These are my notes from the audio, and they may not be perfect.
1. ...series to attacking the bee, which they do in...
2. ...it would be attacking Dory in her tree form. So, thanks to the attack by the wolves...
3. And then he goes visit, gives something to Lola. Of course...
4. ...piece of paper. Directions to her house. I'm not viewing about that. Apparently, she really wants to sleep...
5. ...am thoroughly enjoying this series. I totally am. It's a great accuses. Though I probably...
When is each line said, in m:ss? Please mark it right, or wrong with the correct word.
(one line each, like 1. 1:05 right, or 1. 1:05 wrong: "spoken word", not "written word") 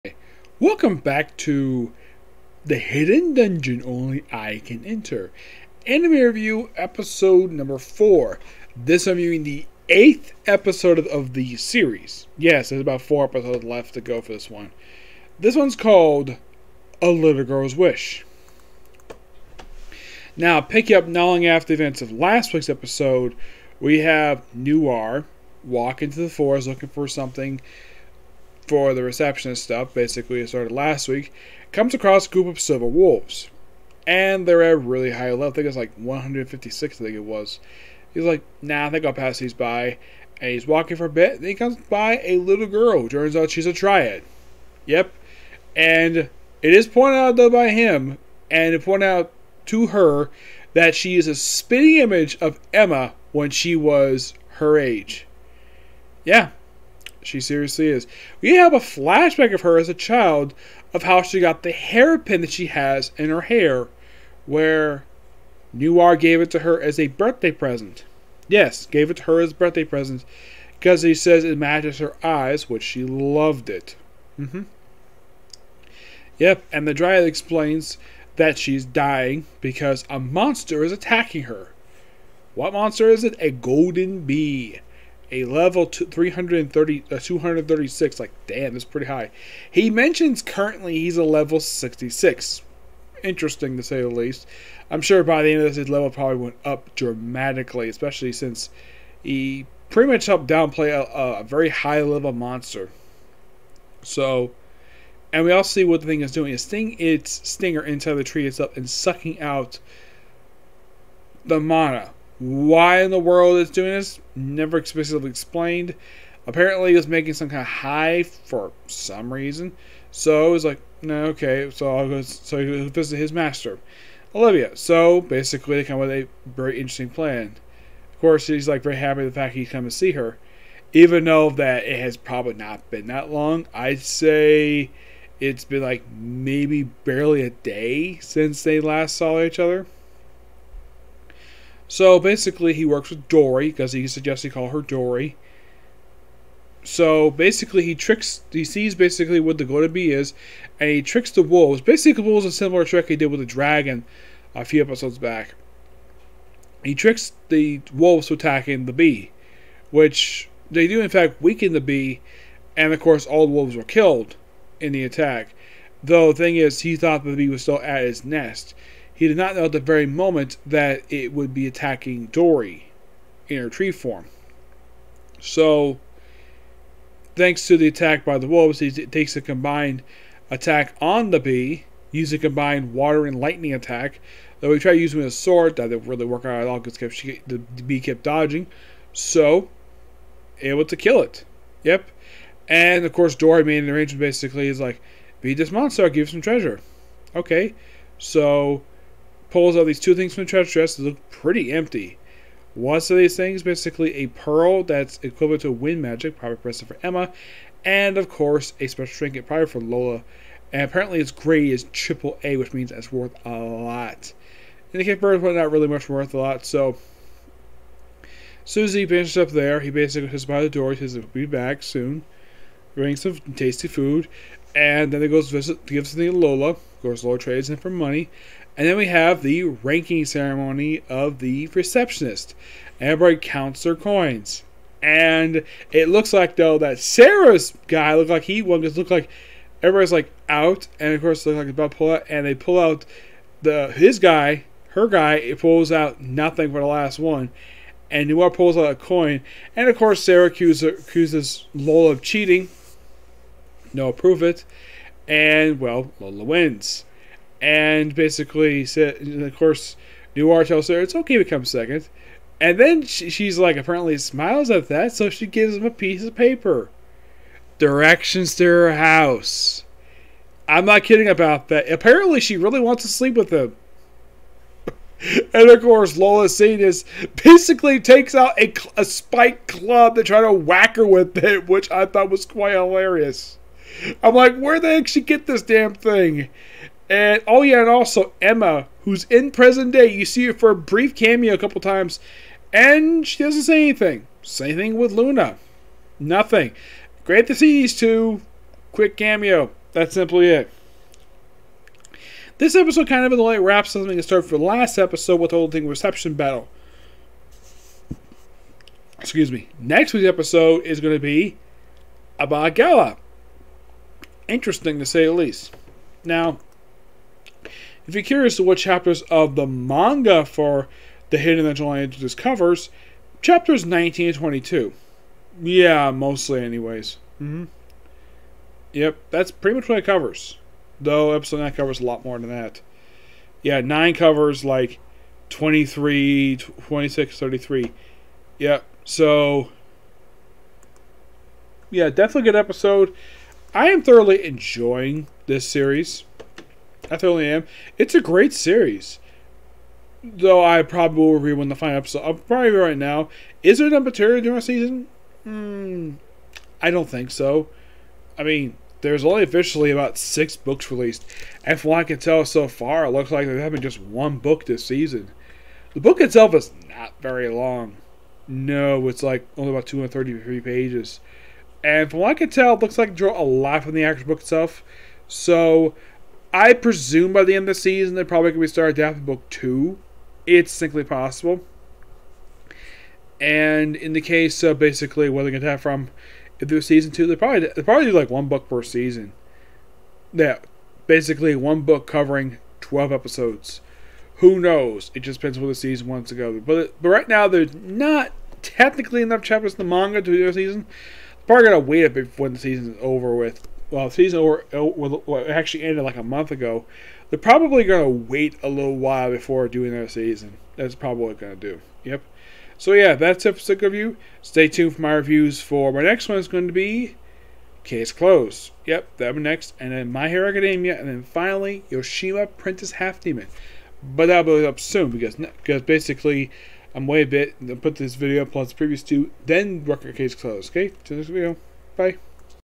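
1. 2:37 wrong: "wolves", not "series"
2. 2:51 right
3. 3:44 right
4. 4:25 wrong: "kidding", not "viewing"
5. 5:43 wrong: "series", not "accuses".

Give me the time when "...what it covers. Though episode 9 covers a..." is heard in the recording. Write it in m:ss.
5:29.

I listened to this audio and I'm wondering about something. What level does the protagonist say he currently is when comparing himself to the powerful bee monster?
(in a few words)
66.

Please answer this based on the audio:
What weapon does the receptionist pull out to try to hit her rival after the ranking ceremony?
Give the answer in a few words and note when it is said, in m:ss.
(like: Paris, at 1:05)
Spike club, at 4:39.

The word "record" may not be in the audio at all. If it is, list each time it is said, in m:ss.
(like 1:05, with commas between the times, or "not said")
7:09.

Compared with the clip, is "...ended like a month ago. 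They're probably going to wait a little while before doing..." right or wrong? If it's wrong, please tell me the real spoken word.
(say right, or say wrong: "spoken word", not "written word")
right.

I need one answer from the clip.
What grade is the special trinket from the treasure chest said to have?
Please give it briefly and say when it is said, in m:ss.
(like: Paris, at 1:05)
Triple A, at 3:31.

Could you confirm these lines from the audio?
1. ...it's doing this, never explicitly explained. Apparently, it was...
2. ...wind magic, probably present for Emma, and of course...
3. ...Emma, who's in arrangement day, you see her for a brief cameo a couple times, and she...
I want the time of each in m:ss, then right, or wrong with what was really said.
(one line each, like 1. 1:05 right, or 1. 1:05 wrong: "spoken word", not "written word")
1. 1:53 right
2. 3:25 right
3. 4:48 wrong: "present", not "arrangement".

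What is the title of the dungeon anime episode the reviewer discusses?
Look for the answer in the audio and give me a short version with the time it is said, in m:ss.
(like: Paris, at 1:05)
A Little Girl's Wish, at 0:17.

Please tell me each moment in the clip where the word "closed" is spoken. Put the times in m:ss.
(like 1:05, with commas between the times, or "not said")
6:58, 7:10.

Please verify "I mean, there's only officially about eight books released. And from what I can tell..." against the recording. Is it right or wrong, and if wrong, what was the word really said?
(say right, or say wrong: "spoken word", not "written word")
wrong: "six", not "eight".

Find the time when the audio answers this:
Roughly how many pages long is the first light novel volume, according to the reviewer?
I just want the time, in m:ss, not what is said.
6:09.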